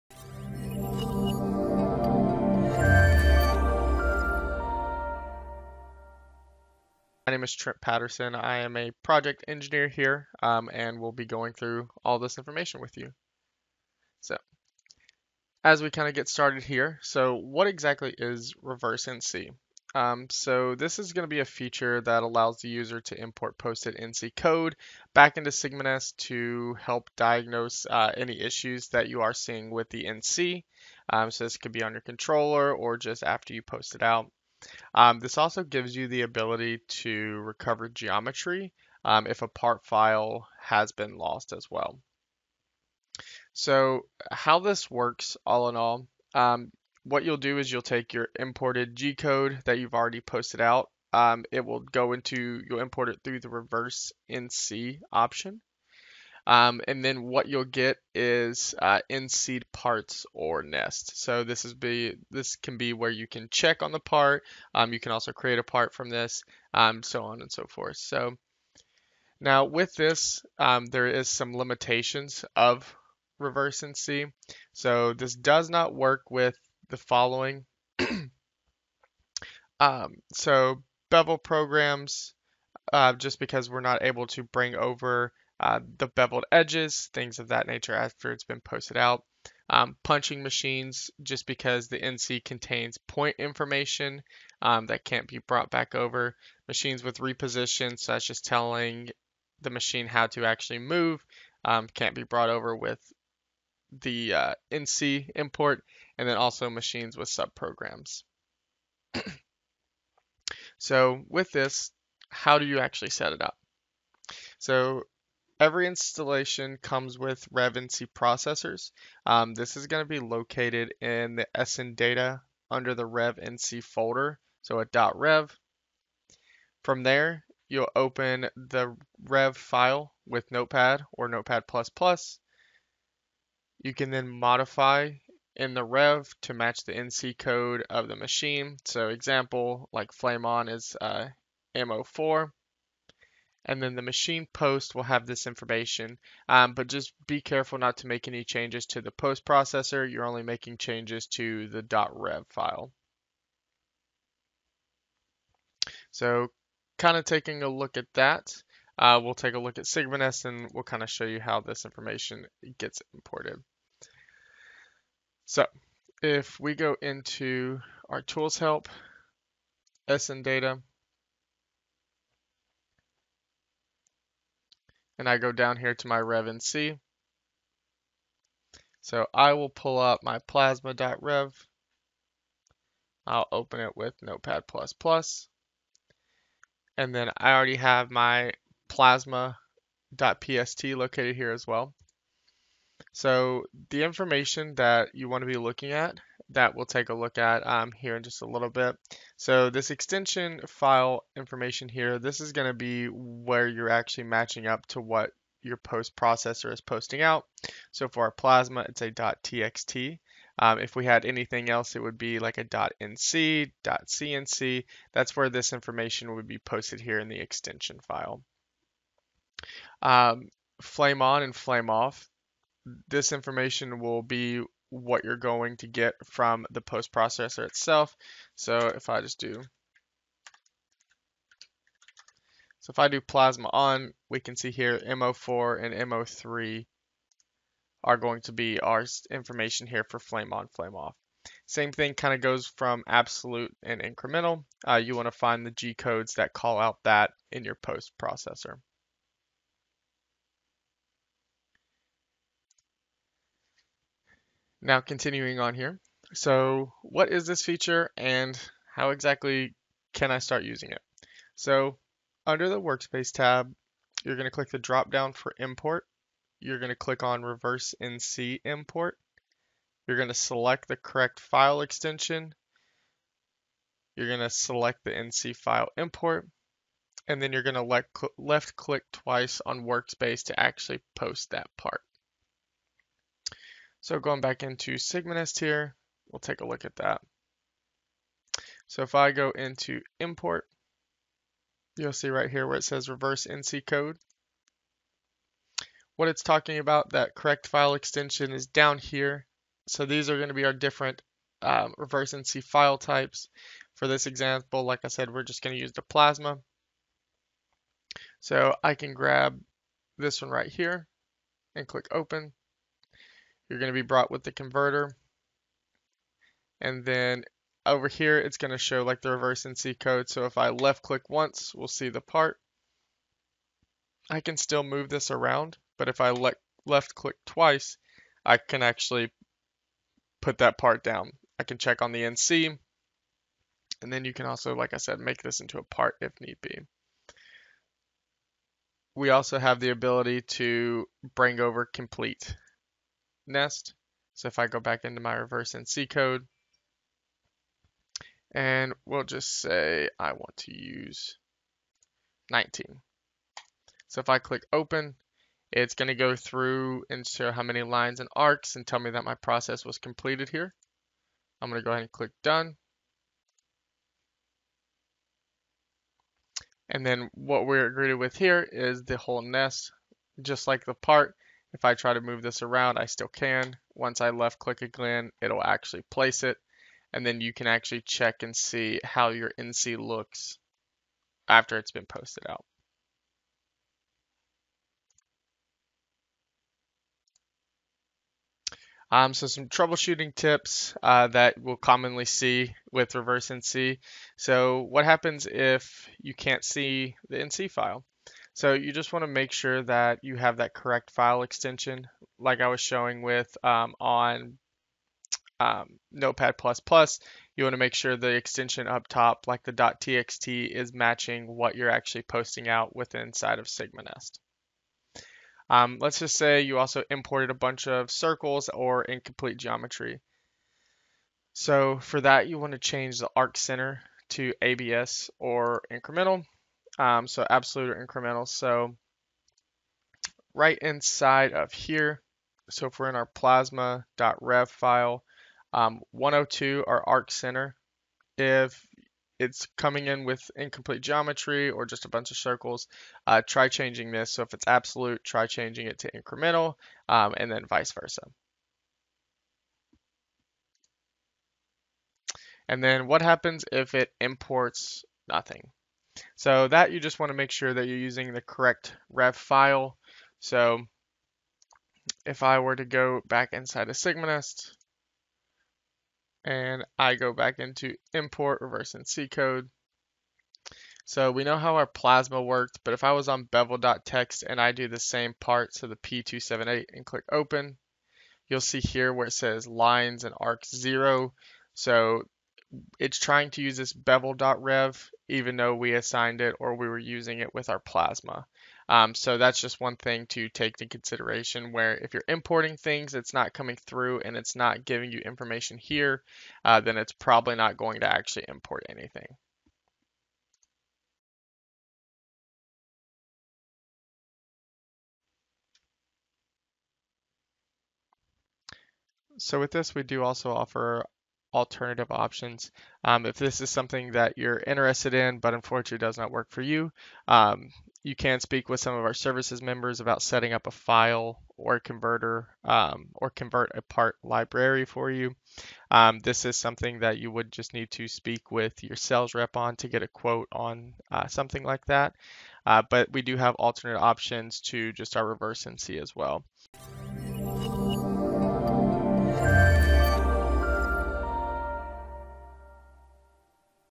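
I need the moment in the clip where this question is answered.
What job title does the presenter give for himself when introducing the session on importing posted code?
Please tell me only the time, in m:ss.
0:08.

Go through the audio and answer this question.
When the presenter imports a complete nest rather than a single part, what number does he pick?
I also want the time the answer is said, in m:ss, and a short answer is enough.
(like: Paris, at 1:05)
19, at 5:52.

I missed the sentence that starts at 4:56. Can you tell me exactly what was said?
What it's talking about, that correct file extension is down here.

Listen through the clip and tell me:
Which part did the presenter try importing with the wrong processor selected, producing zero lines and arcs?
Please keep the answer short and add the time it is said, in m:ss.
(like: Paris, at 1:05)
P278, at 7:55.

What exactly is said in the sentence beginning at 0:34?
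Um, this also gives you the ability to recover geometry um, if a part file has been lost as well.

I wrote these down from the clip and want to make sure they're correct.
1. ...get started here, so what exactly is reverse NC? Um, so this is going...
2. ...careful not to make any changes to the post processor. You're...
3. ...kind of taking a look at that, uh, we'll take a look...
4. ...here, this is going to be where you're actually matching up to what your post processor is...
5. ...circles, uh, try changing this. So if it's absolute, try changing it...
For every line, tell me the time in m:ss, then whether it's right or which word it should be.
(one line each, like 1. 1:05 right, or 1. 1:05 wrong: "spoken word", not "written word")
1. 0:16 right
2. 2:27 right
3. 2:36 right
4. 3:21 right
5. 7:22 right.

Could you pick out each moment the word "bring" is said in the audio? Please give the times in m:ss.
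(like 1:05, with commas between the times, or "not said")
1:24, 5:41.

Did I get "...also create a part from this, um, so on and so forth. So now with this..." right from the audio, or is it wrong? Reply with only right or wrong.
right.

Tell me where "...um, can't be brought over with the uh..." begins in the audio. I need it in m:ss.
1:41.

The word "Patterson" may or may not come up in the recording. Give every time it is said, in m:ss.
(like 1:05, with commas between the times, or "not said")
0:07.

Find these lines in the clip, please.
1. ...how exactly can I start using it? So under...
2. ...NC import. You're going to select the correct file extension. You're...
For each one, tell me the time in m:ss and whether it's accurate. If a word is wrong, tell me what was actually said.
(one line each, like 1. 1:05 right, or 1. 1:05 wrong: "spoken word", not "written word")
1. 4:18 right
2. 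4:28 right.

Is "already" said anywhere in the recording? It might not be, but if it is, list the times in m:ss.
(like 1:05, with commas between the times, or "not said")
0:49, 3:07.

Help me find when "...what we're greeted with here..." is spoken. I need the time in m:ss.
6:07.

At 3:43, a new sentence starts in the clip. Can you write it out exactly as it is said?
This information will be what you're going to get from the post processor itself.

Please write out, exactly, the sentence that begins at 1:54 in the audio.
So Every installation comes with RevNC processors.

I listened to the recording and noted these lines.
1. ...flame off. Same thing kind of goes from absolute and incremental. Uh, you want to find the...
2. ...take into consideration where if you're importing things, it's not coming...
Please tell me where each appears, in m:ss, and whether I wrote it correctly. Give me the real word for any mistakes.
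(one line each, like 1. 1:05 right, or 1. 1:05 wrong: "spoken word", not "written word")
1. 4:00 right
2. 8:10 right.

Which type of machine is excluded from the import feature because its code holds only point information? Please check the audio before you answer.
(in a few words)
punching machines.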